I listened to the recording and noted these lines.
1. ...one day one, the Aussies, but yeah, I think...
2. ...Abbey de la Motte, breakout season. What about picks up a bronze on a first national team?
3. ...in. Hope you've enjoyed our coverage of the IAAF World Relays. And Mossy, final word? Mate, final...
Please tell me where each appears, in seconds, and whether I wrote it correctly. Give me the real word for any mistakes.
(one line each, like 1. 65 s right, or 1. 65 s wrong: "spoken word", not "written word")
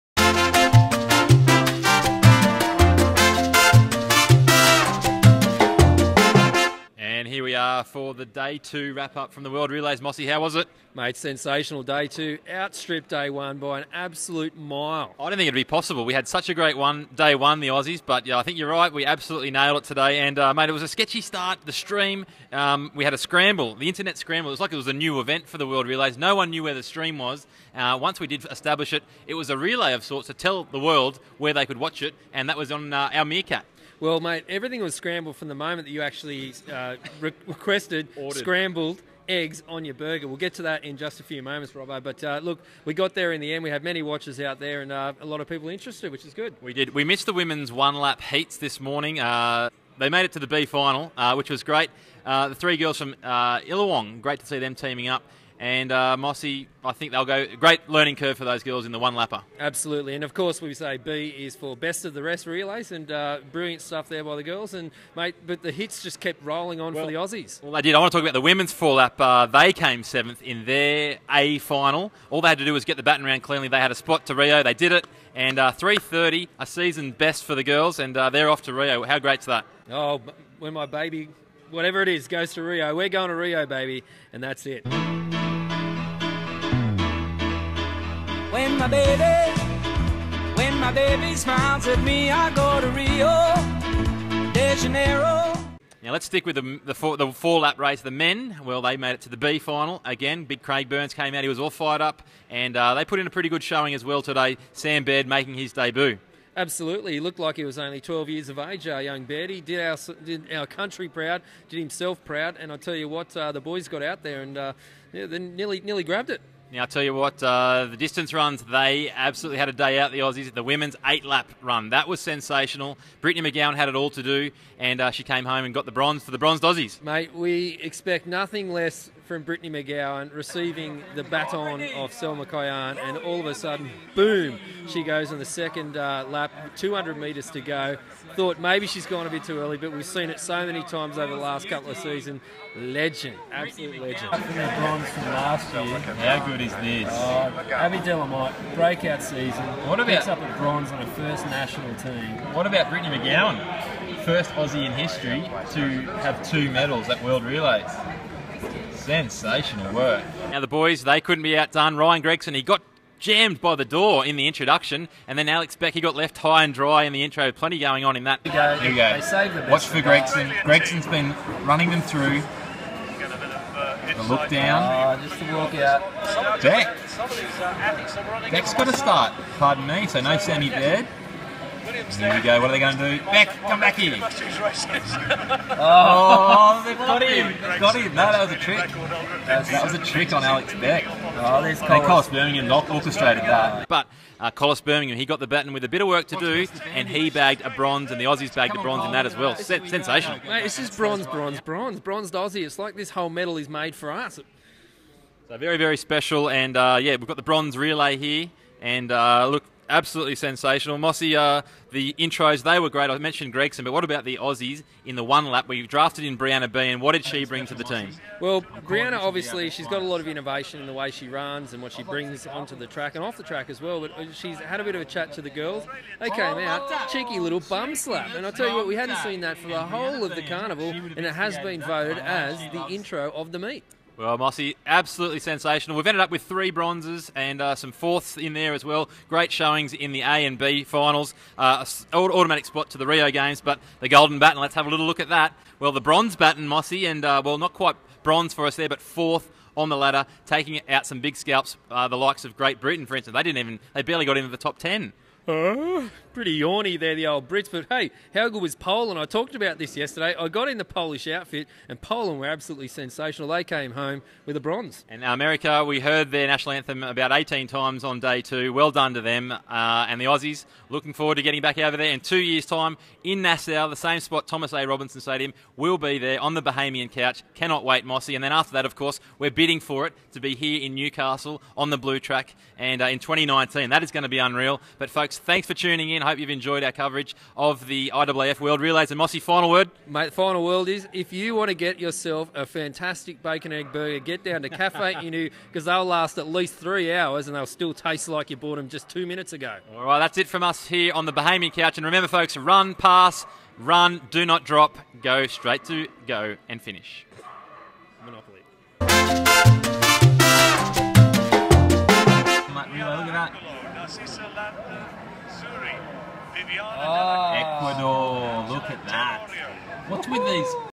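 1. 16 s right
2. 147 s right
3. 286 s right.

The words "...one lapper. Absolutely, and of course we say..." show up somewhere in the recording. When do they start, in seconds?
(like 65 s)
58 s.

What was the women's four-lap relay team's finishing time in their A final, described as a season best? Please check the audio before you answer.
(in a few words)
3:30.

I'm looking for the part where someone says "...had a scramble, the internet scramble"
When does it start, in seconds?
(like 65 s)
23 s.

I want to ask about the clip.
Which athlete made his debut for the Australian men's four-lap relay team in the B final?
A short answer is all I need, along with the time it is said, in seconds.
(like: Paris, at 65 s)
Sam Baird, at 104 s.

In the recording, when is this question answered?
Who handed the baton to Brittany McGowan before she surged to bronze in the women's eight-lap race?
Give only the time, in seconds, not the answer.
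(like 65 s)
132 s.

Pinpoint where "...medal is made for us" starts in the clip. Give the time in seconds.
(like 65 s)
203 s.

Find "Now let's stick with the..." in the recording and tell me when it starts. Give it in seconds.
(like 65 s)
96 s.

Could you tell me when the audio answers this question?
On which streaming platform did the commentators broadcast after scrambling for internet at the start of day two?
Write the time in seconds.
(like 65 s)
33 s.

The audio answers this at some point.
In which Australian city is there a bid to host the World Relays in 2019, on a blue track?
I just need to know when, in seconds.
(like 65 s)
280 s.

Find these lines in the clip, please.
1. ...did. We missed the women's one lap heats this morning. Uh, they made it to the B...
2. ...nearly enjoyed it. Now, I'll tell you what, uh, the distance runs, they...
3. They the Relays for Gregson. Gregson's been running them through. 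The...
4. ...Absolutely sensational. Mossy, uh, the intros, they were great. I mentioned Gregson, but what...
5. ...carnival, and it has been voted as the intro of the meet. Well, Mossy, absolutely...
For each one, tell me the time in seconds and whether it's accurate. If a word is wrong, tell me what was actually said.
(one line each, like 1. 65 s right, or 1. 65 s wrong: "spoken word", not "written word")
1. 46 s right
2. 115 s wrong: "grabbed", not "enjoyed"
3. 169 s wrong: "Watch", not "Relays"
4. 209 s right
5. 230 s right.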